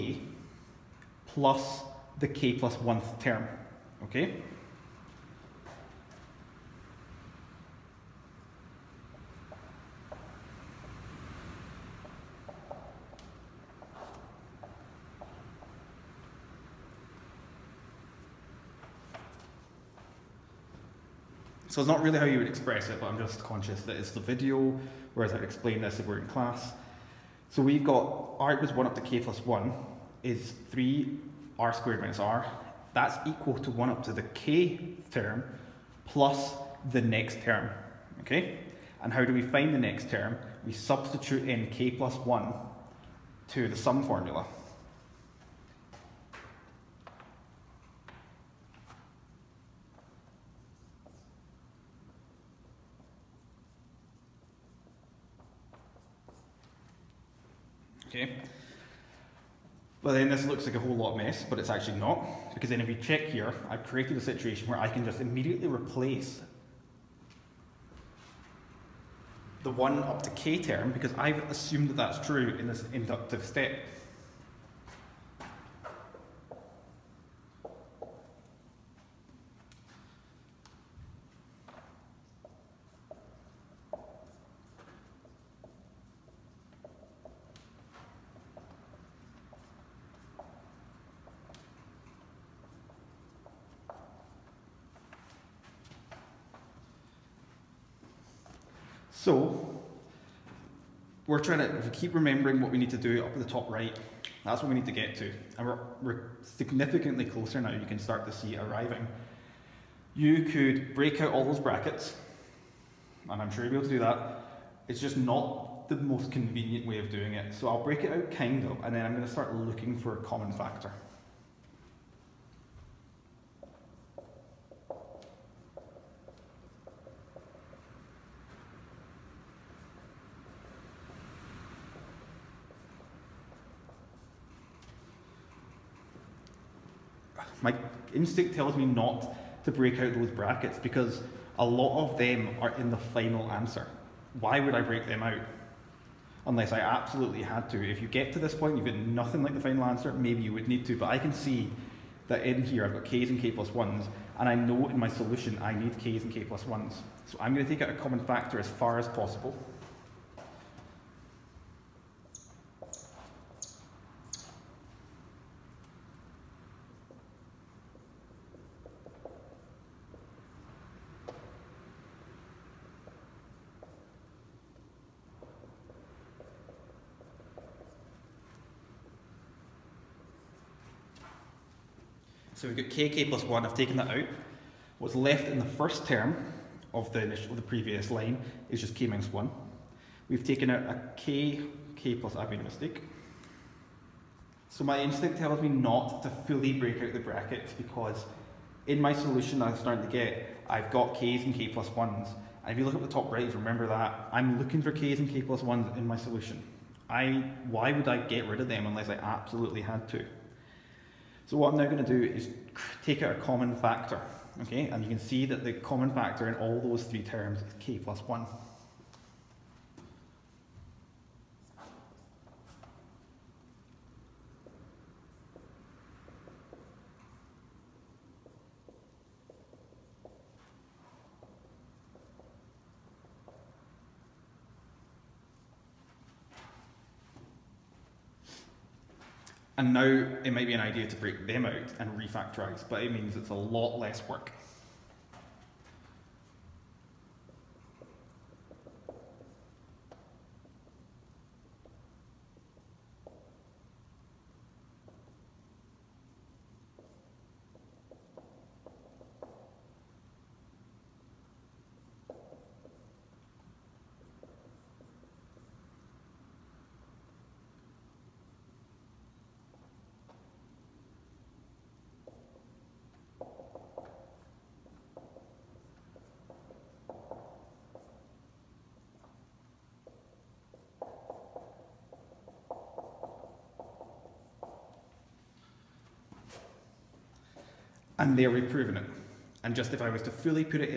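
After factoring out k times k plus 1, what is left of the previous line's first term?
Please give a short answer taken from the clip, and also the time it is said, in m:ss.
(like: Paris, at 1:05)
k minus 1, at 3:08.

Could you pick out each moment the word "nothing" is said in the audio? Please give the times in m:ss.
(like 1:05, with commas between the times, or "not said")
2:28.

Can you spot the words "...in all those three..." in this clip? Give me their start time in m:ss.
3:36.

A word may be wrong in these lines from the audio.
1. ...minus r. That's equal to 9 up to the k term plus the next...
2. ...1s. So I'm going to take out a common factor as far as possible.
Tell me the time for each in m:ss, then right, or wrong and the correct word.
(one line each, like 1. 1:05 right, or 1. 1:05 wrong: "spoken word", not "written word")
1. 0:32 wrong: "1", not "9"
2. 2:36 right.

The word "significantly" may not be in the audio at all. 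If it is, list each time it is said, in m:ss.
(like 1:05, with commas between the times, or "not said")
1:46.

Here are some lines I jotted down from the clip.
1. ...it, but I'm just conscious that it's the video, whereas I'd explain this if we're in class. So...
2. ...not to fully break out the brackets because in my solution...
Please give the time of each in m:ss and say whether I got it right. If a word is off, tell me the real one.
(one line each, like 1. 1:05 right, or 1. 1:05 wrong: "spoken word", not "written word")
1. 0:22 right
2. 3:15 right.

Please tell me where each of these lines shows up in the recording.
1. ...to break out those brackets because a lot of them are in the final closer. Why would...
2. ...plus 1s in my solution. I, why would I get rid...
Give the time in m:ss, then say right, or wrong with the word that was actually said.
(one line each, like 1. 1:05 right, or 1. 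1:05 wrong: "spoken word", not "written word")
1. 2:19 wrong: "answer", not "closer"
2. 3:25 right.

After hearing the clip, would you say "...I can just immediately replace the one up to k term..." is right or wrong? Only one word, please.
right.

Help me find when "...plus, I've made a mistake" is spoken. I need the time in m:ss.
3:12.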